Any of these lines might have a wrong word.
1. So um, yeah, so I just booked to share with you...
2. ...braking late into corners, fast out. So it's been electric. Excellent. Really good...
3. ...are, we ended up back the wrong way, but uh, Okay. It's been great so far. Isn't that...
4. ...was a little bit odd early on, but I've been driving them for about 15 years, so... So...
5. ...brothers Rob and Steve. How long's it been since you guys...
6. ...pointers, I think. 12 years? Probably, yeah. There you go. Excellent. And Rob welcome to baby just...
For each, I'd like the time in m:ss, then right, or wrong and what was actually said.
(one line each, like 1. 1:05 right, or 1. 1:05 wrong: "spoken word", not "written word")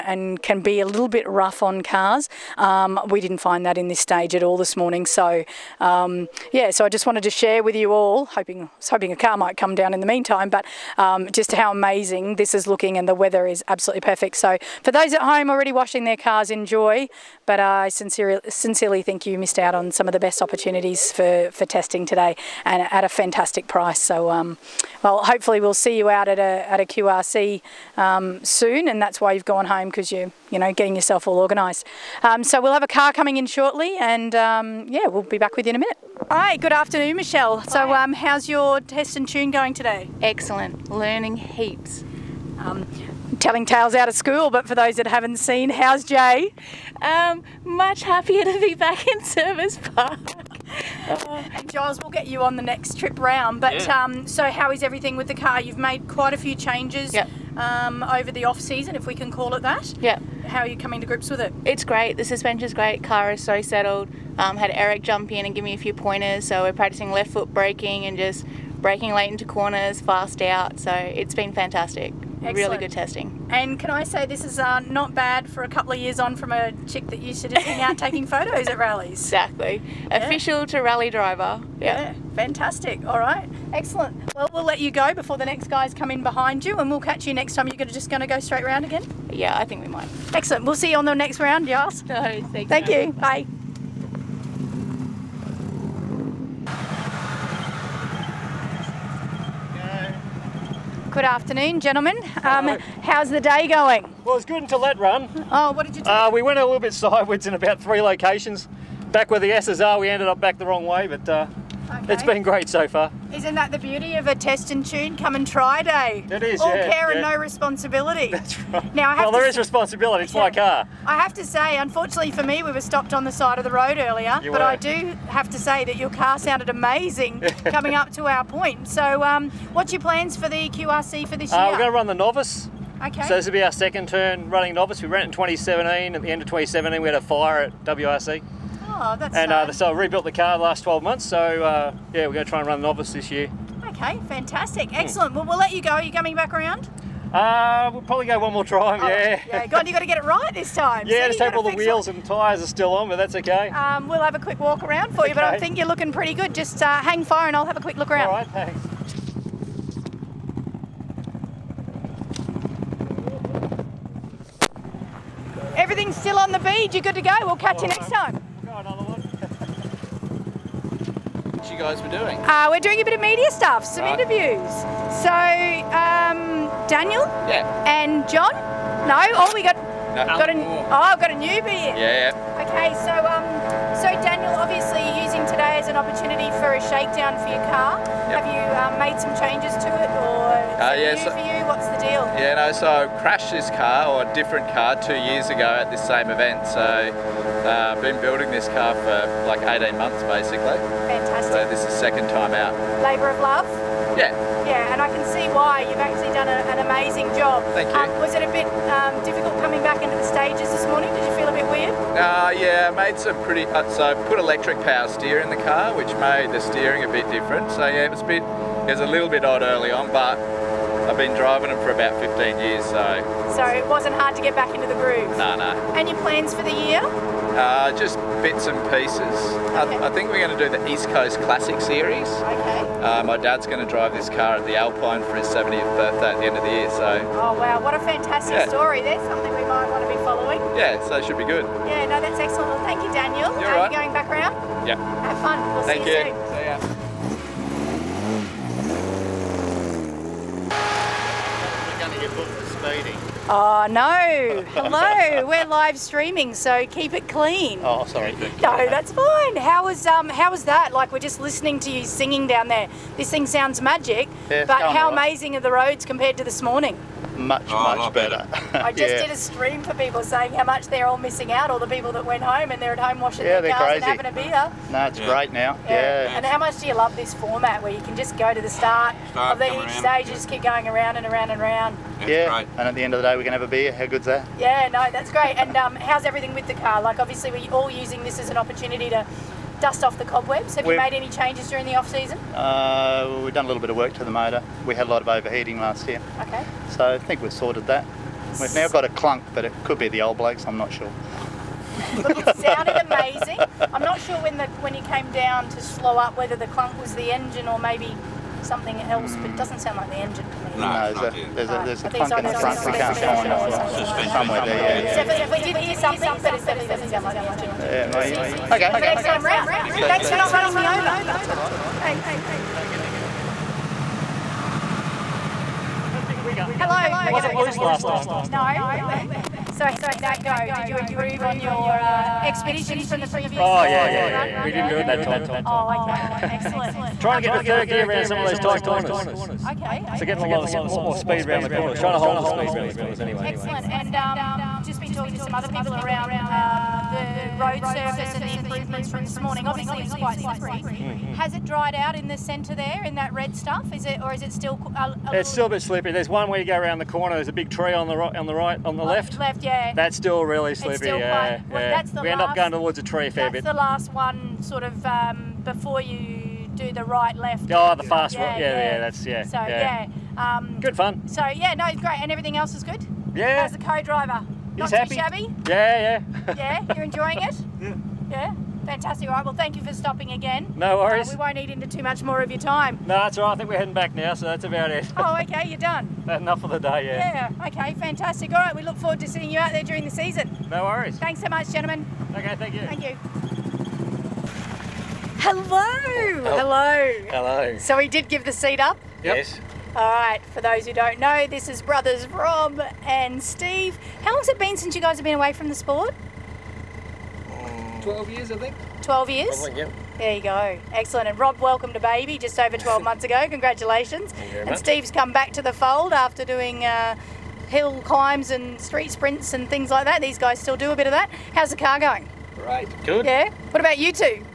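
1. 0:05 wrong: "wanted", not "booked"
2. 1:08 wrong: "fantastic", not "electric"
3. 1:49 right
4. 3:38 right
5. 6:41 right
6. 6:48 wrong: "years", not "pointers".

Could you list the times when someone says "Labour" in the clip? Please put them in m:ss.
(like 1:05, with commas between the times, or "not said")
3:23.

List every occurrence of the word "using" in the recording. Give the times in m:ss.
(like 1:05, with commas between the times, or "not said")
3:05, 4:47.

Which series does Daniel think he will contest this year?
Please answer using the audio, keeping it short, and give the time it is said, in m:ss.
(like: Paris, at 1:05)
East Coast Classic Series, at 3:50.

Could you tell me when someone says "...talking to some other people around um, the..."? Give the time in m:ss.
5:45.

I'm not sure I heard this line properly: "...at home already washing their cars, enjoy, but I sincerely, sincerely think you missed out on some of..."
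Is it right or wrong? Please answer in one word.
right.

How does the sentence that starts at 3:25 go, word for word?
You've actually done a, an amazing job.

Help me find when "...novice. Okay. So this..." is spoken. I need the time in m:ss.
2:12.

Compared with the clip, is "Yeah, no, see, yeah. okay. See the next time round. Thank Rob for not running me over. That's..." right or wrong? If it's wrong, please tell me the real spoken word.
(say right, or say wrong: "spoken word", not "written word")
wrong: "Thanks", not "Rob".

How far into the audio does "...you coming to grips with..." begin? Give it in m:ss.
1:00.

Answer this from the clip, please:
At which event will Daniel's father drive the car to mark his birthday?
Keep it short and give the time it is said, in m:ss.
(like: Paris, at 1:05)
the Alpine, at 3:54.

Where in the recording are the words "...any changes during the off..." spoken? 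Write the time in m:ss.
4:51.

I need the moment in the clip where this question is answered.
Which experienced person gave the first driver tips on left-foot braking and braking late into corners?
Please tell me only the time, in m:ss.
1:04.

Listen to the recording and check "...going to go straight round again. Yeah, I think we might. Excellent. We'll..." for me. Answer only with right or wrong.
right.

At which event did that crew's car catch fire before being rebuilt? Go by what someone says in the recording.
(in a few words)
WRC.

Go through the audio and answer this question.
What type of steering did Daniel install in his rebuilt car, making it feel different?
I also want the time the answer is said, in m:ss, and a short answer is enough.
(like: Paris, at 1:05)
Electric power steer, at 3:34.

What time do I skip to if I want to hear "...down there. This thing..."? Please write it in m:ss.
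4:22.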